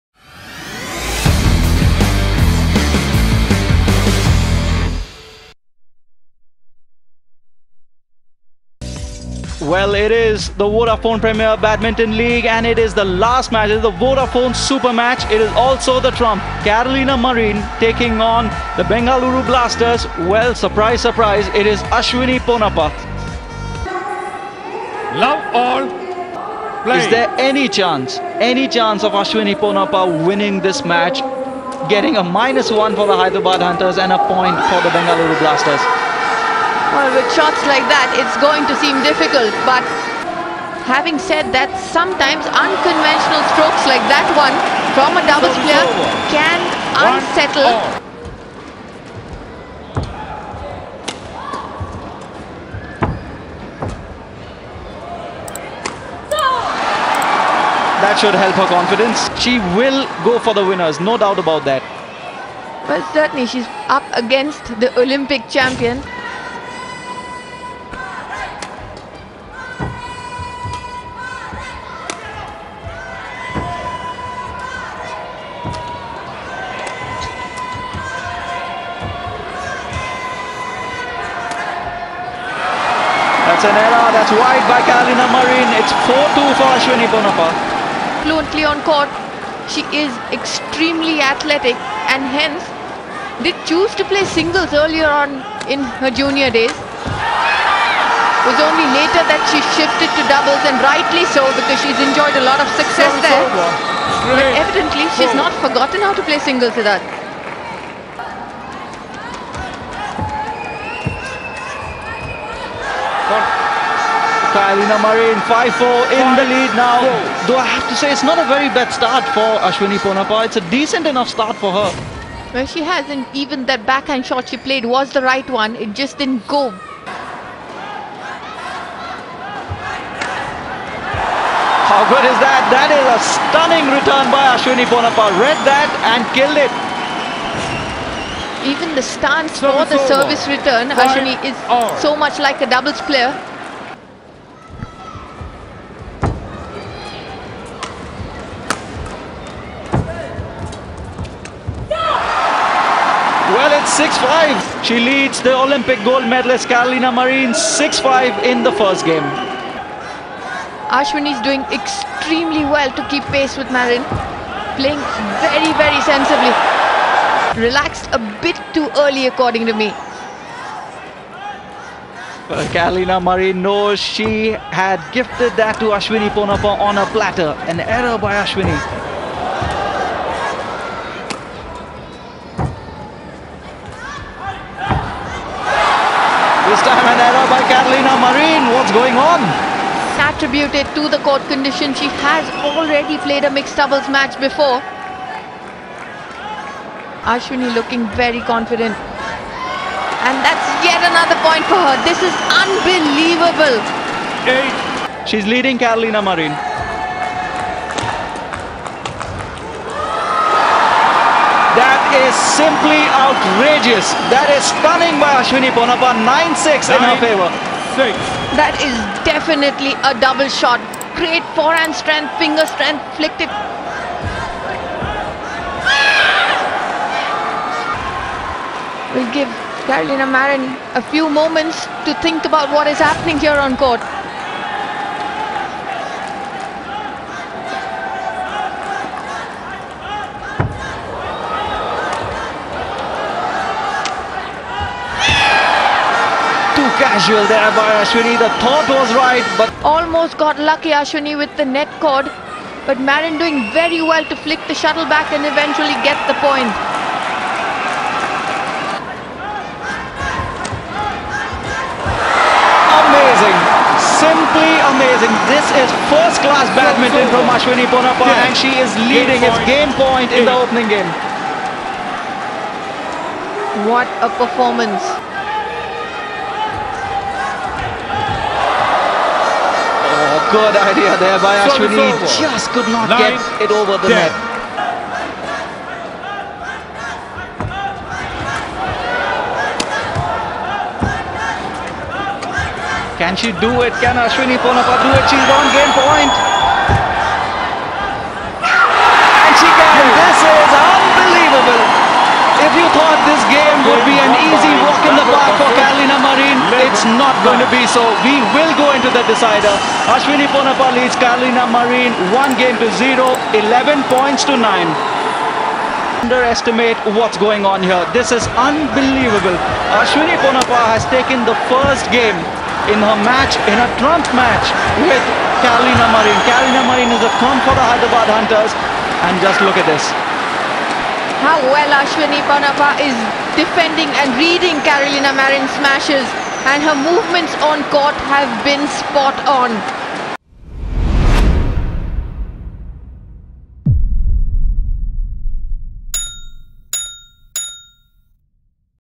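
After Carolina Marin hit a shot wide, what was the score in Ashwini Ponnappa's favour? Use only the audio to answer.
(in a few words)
4-2.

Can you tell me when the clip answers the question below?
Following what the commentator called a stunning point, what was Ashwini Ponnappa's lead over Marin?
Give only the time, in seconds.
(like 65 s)
216 s.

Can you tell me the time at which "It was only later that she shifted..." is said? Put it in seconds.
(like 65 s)
96 s.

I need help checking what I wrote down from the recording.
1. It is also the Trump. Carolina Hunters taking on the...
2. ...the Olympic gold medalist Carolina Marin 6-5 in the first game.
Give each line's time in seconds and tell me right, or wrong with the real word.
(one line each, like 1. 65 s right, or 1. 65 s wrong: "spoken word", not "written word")
1. 15 s wrong: "Marin", not "Hunters"
2. 155 s right.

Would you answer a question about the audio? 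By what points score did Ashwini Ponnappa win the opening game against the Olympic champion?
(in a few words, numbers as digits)
11-9.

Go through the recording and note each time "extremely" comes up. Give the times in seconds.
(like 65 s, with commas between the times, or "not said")
90 s, 161 s.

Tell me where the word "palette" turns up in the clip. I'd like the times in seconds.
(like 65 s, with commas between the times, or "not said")
not said.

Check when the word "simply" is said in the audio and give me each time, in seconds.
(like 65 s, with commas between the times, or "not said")
212 s, 264 s.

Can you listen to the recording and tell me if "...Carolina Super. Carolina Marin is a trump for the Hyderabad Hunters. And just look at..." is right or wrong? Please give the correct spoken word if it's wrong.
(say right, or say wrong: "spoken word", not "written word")
wrong: "Marin", not "Super".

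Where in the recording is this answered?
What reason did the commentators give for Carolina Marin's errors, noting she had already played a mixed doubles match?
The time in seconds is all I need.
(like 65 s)
191 s.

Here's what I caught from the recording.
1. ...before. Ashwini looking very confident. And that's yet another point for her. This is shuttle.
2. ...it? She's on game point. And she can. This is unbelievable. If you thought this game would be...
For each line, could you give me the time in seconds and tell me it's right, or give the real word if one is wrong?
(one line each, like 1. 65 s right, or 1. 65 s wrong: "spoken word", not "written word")
1. 194 s wrong: "unbelievable", not "shuttle"
2. 295 s right.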